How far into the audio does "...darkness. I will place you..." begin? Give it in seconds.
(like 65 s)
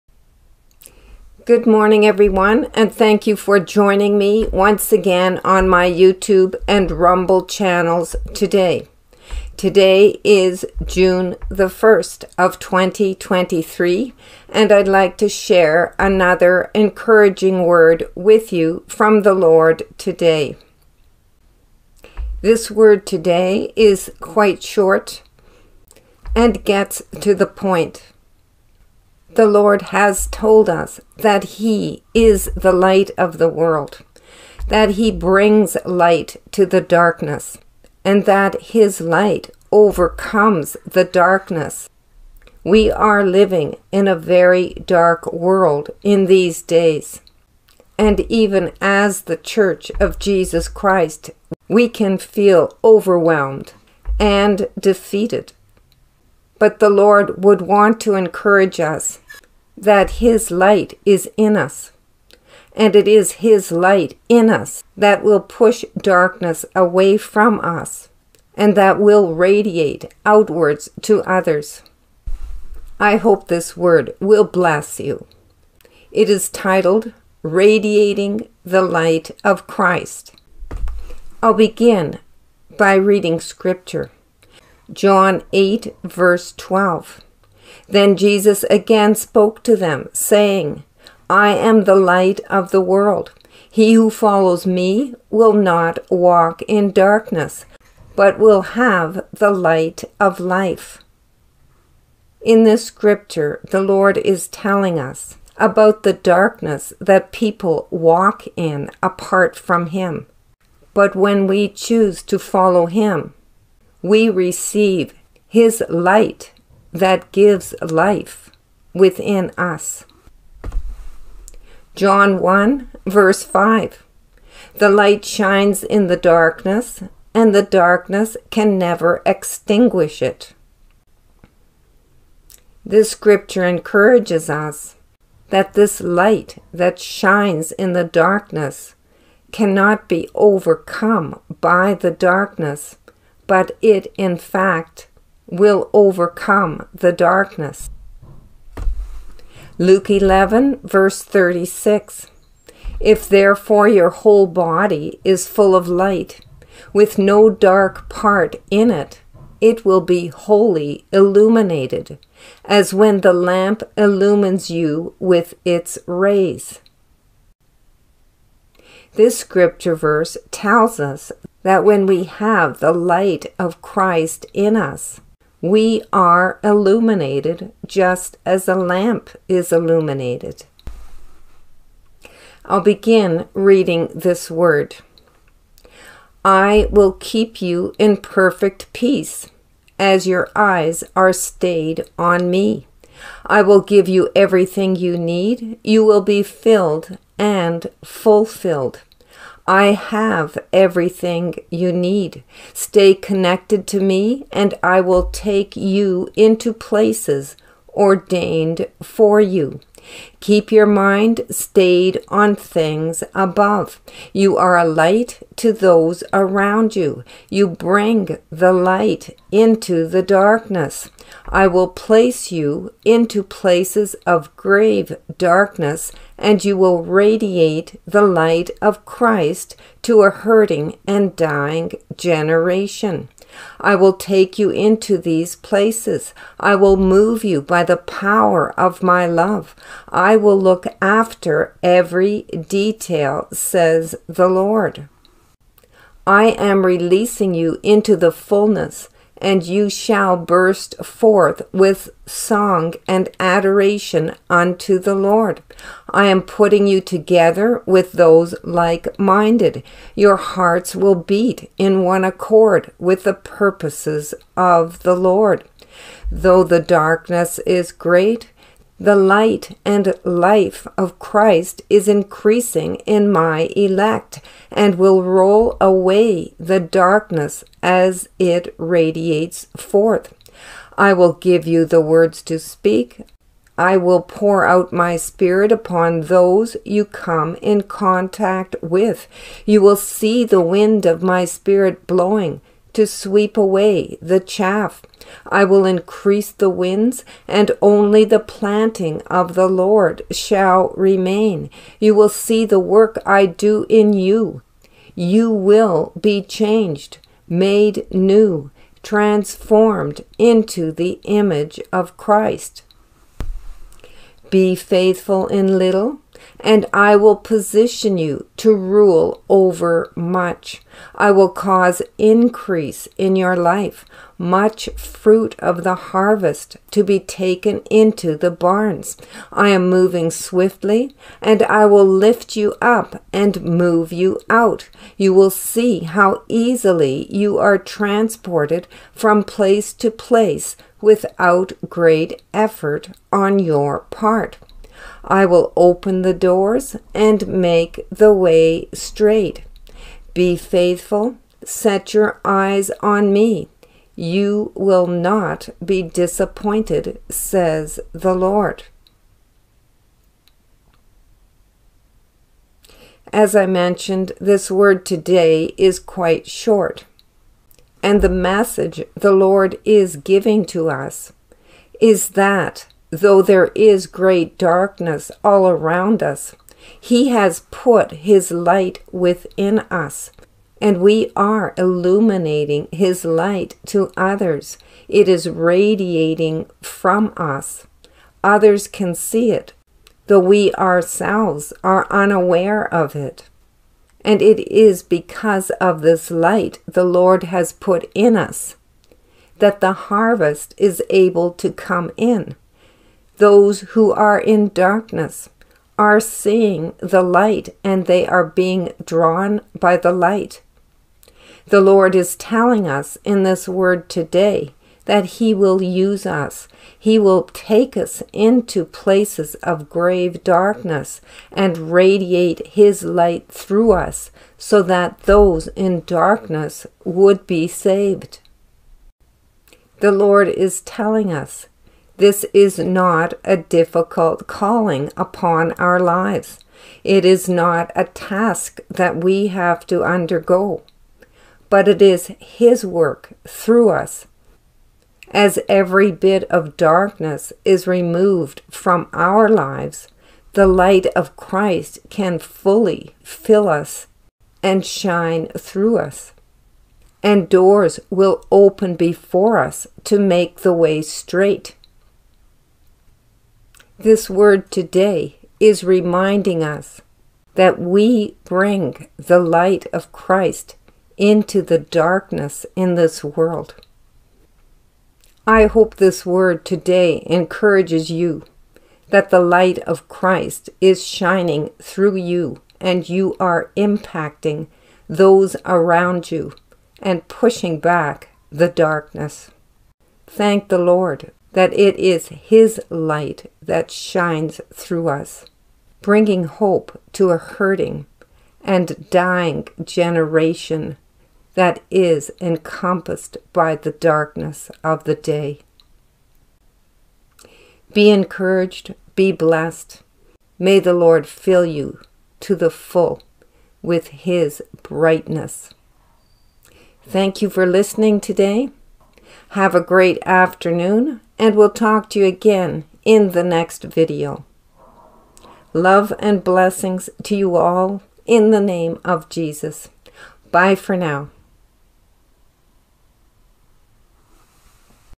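220 s.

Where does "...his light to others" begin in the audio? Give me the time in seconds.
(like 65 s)
382 s.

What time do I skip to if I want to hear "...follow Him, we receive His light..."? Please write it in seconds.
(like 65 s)
112 s.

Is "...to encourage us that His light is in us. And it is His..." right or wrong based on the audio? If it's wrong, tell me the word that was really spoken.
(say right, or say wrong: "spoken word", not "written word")
right.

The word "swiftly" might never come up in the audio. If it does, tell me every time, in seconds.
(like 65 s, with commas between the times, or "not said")
330 s.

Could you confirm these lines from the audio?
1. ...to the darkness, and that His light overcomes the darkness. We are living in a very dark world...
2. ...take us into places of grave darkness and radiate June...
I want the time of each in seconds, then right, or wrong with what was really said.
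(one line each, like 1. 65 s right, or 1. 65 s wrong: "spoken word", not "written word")
1. 36 s right
2. 417 s wrong: "His", not "June".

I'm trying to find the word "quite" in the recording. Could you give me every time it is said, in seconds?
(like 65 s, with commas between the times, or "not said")
24 s, 365 s.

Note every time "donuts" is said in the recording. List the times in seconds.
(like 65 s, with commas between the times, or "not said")
not said.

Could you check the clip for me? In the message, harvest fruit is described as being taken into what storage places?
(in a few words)
the barns.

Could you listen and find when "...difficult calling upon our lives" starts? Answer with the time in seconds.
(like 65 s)
433 s.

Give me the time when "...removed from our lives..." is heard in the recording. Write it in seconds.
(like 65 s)
447 s.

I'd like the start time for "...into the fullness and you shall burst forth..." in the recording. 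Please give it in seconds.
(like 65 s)
247 s.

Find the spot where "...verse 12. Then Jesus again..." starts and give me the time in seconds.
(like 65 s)
86 s.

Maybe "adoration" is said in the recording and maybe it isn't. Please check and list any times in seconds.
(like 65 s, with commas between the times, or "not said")
253 s.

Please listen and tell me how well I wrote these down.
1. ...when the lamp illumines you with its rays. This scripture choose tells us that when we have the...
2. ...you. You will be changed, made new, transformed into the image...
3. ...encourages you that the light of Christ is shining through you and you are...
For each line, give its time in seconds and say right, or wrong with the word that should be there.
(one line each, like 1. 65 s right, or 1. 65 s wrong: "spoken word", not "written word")
1. 162 s wrong: "verse", not "choose"
2. 304 s right
3. 477 s right.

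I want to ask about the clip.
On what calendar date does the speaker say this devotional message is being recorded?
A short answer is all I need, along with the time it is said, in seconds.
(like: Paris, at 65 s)
June 1, 2023, at 10 s.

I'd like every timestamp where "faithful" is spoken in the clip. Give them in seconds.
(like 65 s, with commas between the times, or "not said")
314 s, 350 s.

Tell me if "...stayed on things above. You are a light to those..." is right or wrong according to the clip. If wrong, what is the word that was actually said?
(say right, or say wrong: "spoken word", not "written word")
right.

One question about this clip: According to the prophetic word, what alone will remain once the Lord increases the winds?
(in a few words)
the planting of the Lord.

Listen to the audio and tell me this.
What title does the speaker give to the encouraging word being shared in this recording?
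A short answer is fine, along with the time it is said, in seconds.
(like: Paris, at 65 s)
Radiating the Light of Christ, at 77 s.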